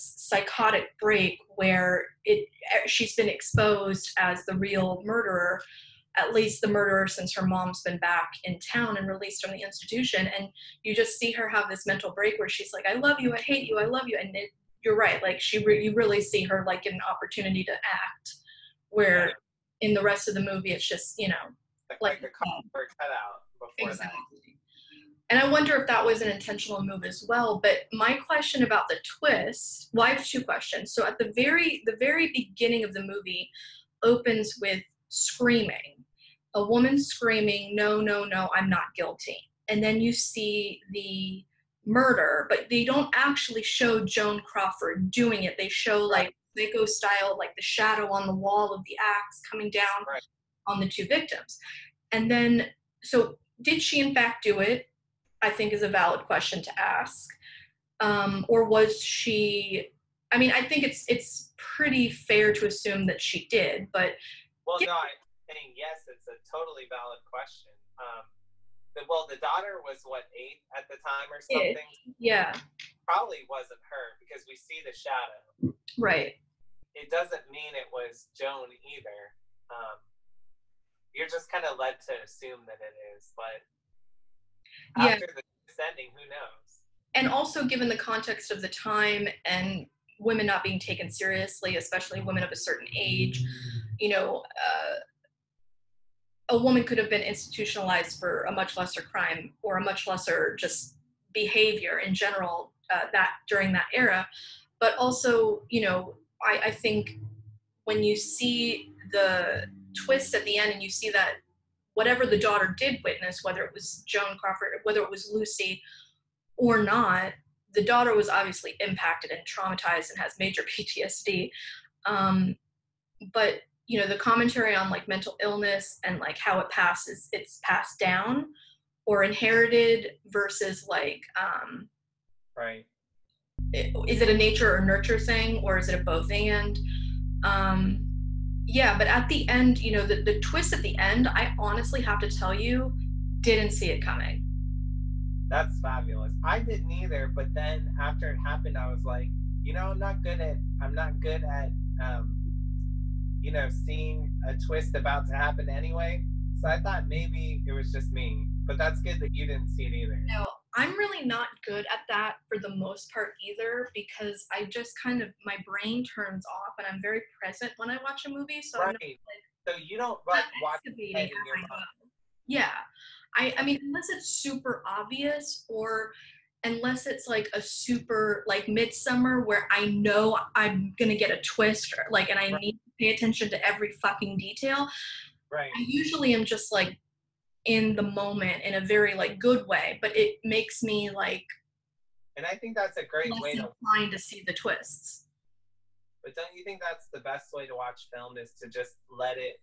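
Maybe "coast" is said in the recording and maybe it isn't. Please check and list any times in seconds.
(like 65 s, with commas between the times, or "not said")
not said.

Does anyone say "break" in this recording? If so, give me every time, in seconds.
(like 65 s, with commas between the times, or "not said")
1 s, 12 s.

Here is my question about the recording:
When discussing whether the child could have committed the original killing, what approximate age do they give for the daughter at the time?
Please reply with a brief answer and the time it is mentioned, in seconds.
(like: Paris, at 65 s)
8, at 70 s.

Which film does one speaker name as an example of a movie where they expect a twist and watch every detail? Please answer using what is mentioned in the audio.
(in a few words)
Midsommar.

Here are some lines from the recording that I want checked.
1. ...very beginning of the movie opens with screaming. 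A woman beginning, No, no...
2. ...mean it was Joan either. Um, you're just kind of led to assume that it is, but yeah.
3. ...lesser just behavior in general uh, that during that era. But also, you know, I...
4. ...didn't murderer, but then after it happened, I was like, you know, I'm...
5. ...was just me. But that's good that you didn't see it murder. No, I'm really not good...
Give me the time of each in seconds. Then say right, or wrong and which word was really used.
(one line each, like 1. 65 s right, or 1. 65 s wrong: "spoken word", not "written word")
1. 31 s wrong: "screaming", not "beginning"
2. 77 s right
3. 100 s right
4. 146 s wrong: "either", not "murderer"
5. 157 s wrong: "either", not "murder".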